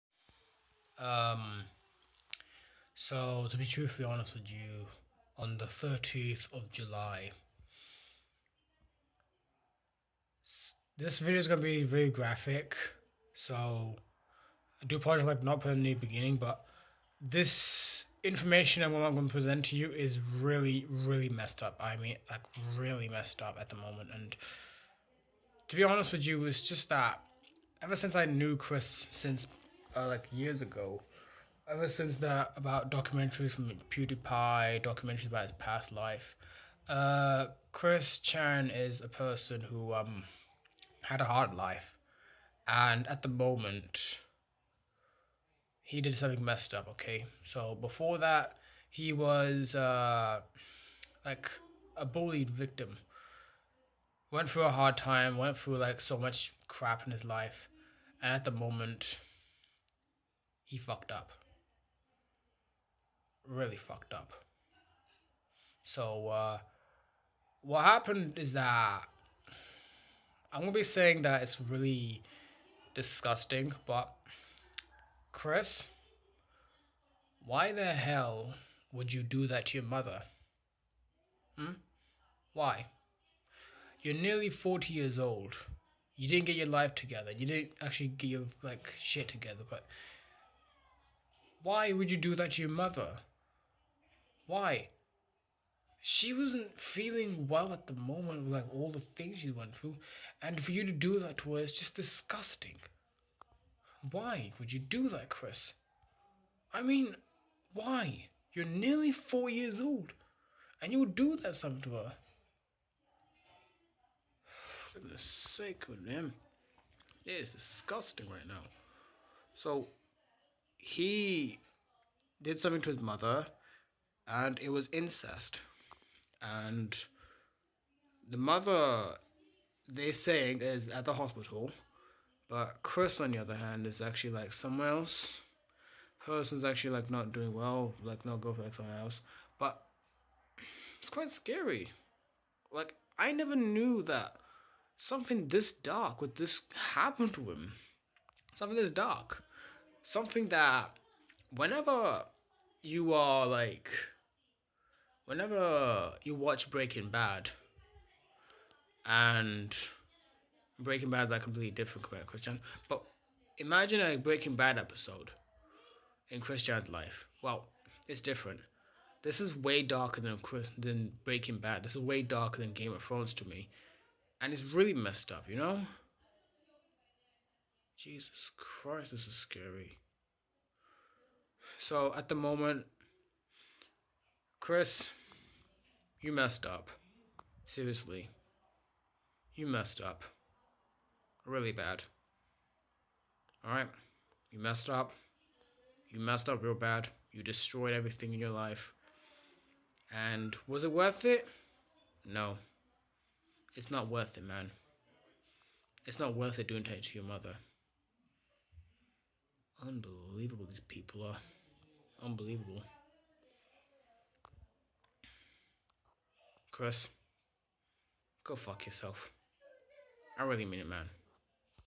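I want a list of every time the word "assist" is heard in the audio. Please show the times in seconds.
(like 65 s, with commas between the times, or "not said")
not said.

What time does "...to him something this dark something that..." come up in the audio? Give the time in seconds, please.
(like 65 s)
147 s.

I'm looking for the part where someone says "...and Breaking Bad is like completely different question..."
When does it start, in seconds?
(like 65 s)
159 s.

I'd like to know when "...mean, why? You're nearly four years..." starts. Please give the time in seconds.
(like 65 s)
106 s.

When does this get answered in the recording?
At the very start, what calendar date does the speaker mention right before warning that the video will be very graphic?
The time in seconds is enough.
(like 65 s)
5 s.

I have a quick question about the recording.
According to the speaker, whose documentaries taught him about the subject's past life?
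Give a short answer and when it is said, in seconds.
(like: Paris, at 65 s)
PewDiePie, at 33 s.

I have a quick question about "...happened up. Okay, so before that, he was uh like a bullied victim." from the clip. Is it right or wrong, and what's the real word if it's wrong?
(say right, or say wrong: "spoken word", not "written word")
wrong: "messed", not "happened".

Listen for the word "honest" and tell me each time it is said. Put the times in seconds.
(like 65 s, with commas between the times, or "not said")
4 s, 25 s.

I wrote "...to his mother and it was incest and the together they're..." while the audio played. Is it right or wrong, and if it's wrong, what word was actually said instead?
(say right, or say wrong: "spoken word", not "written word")
wrong: "mother", not "together".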